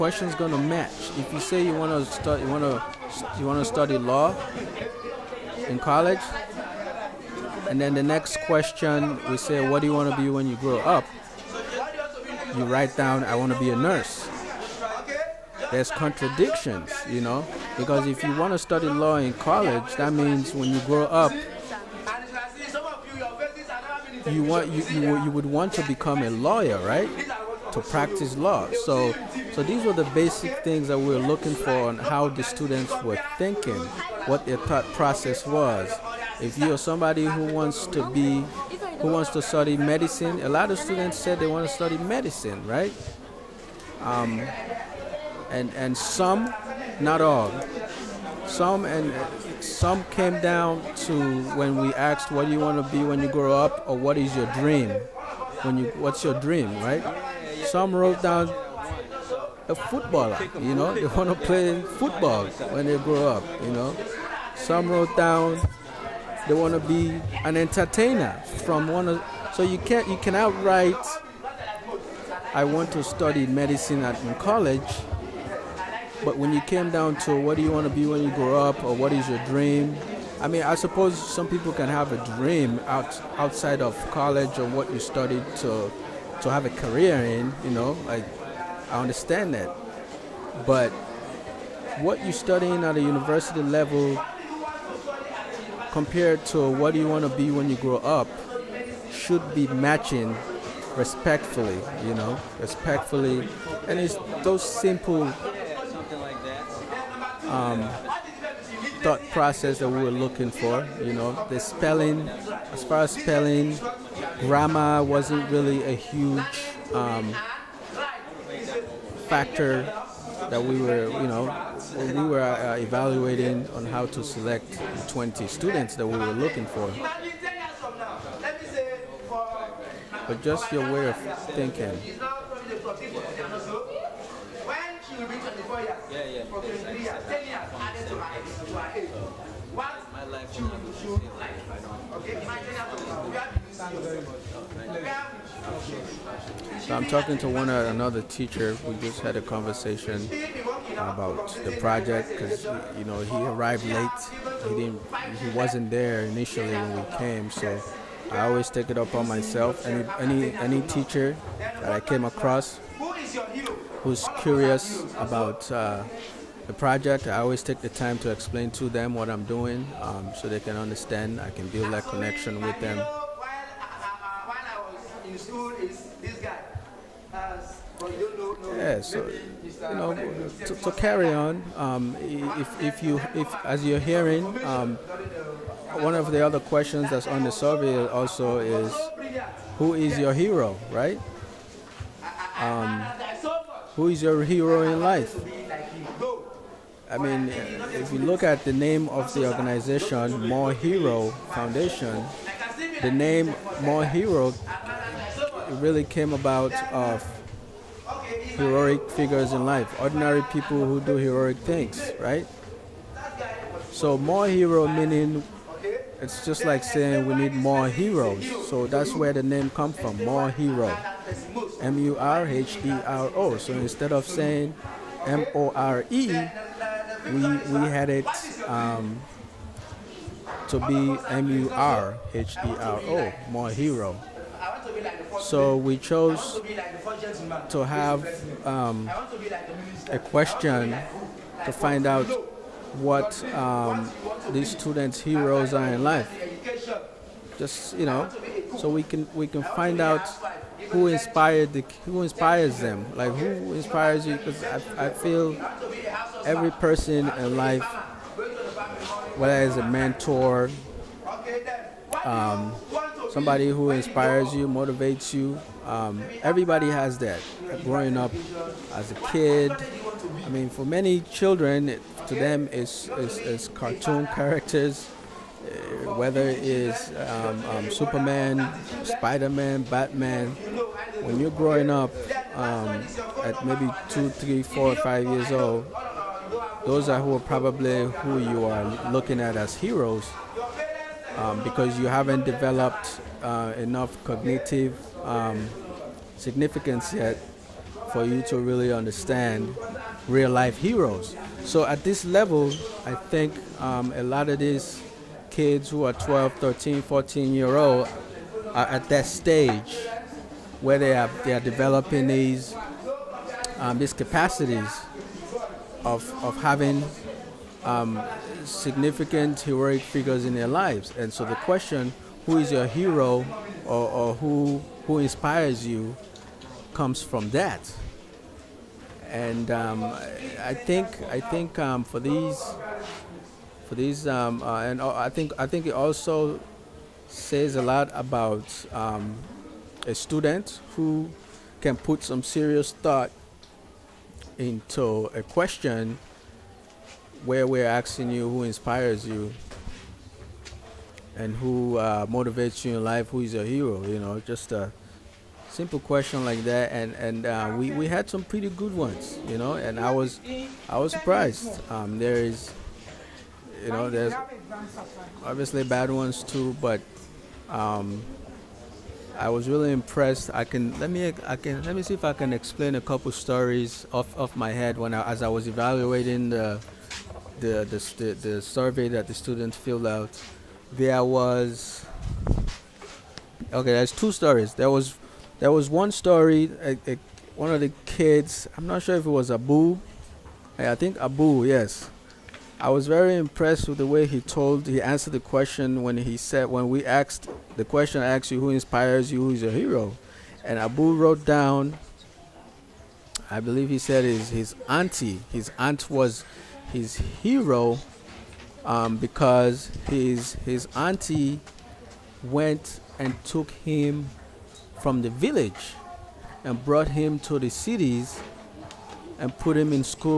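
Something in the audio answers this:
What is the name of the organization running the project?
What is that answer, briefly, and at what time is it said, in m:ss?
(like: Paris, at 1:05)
More Hero Foundation, at 3:20.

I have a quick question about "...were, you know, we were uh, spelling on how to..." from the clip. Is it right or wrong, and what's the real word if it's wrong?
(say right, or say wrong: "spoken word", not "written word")
wrong: "evaluating", not "spelling".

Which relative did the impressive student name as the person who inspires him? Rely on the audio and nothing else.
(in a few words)
his aunt.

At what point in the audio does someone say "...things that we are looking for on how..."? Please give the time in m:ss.
0:30.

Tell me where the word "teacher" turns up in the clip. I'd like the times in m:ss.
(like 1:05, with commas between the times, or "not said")
2:28, 2:40.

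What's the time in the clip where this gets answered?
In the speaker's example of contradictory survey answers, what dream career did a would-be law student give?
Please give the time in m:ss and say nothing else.
0:13.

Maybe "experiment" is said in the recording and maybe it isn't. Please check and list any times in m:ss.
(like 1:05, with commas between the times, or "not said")
not said.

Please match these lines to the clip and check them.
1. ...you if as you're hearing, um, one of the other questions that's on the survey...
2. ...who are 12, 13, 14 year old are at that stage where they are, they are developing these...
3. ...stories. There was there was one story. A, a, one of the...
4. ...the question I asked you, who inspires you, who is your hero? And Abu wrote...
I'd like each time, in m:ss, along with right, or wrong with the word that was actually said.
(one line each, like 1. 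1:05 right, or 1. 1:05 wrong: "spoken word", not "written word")
1. 3:03 right
2. 5:05 right
3. 6:24 right
4. 6:37 right.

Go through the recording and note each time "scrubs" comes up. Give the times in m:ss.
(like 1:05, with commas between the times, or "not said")
not said.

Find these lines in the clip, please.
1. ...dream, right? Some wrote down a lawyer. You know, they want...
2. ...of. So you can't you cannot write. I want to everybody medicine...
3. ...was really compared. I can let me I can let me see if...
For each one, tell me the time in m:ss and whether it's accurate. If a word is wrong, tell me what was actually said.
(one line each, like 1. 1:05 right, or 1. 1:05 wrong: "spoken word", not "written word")
1. 0:56 wrong: "footballer", not "lawyer"
2. 1:09 wrong: "study", not "everybody"
3. 6:09 wrong: "impressed", not "compared".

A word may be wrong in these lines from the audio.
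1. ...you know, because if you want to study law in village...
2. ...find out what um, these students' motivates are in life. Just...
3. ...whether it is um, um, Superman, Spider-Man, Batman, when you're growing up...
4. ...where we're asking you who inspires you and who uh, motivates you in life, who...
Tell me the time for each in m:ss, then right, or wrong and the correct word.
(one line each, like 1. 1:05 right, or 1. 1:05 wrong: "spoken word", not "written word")
1. 0:17 wrong: "college", not "village"
2. 4:01 wrong: "heroes", not "motivates"
3. 4:36 right
4. 5:47 right.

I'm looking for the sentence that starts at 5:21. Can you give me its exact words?
And so the question, who is your hero or, or who, who inspires you, comes from that.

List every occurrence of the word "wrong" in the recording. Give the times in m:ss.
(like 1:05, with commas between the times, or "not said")
not said.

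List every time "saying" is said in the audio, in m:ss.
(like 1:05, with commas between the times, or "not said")
3:36, 3:44.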